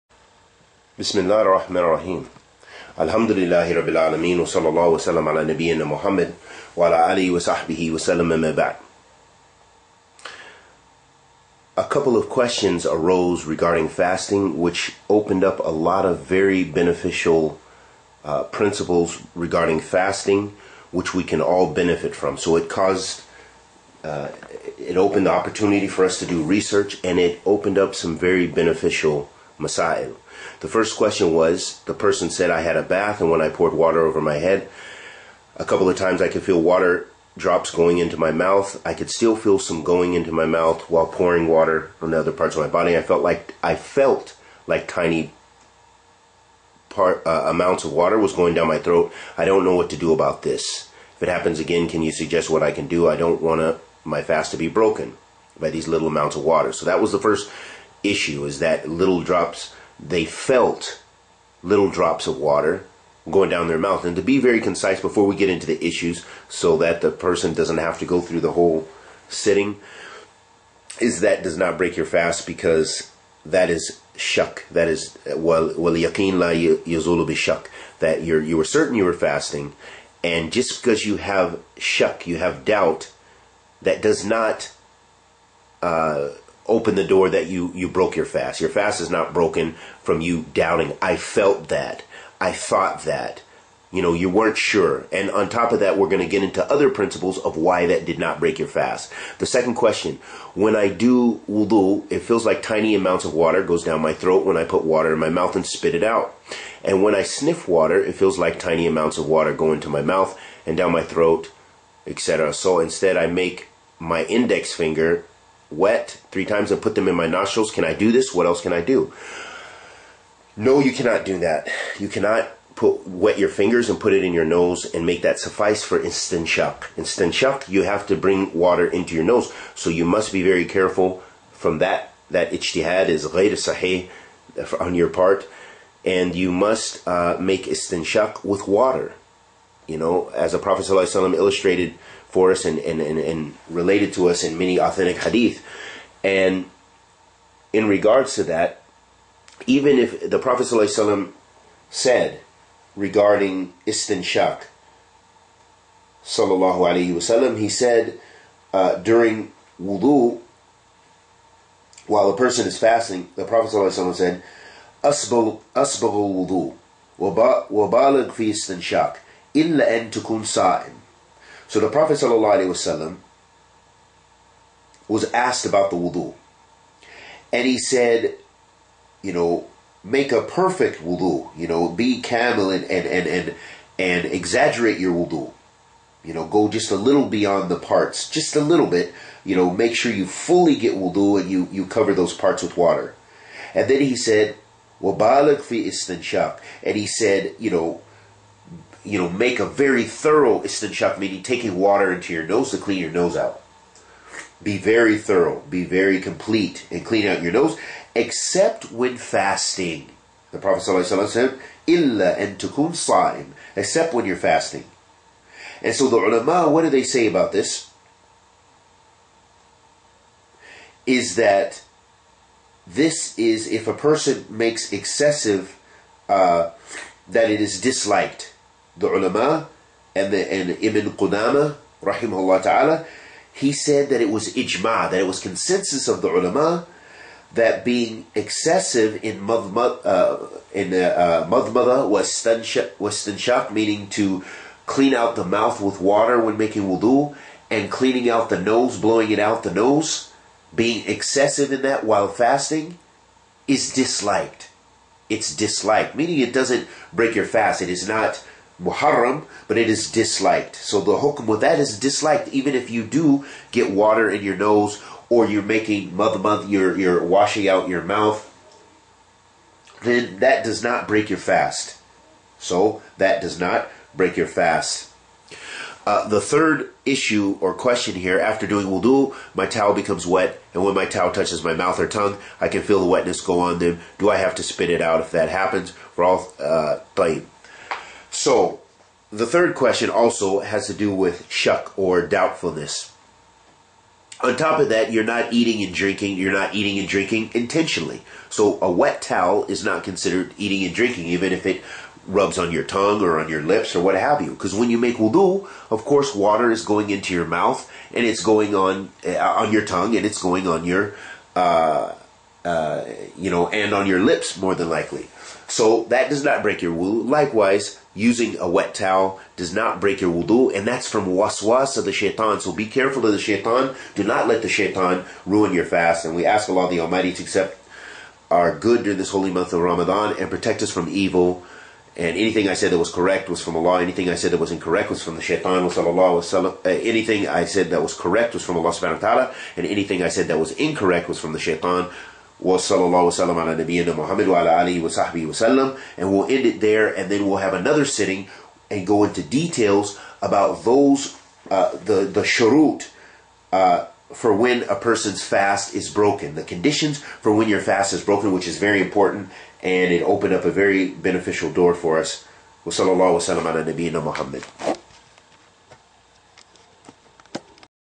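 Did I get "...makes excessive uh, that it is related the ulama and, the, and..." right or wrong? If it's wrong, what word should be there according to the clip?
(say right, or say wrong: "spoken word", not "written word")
wrong: "disliked", not "related".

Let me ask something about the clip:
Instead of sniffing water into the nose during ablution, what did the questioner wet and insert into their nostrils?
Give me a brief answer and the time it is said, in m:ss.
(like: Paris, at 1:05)
index finger, at 1:54.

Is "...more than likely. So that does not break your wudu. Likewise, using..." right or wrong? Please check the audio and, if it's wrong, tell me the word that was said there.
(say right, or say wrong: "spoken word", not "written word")
right.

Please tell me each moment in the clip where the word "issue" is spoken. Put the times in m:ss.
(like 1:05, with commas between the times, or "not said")
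0:58, 1:05, 4:37.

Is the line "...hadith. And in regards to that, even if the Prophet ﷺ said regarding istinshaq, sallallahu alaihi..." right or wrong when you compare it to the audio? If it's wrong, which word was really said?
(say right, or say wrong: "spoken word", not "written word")
right.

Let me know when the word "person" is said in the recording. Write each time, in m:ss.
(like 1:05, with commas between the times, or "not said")
0:31, 1:07, 2:42, 3:43, 5:54.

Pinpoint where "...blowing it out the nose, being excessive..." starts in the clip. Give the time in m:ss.
4:08.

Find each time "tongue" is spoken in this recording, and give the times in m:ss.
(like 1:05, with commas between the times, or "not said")
4:42, 5:02, 5:09.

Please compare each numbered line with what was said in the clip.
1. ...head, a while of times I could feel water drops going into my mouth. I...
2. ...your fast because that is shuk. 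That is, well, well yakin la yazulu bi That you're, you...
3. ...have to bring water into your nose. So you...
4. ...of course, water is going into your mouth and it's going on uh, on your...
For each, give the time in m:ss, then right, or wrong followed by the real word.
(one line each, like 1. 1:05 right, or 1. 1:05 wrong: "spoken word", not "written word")
1. 0:34 wrong: "couple", not "while"
2. 1:11 right
3. 2:07 right
4. 5:05 right.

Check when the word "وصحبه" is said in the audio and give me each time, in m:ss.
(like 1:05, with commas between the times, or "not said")
0:07, 5:45.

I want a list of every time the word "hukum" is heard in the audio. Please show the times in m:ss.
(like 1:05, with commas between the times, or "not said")
4:21.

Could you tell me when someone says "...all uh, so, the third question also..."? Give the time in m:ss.
4:46.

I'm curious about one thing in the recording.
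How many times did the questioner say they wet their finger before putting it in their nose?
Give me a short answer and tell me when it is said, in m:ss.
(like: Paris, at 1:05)
3, at 1:56.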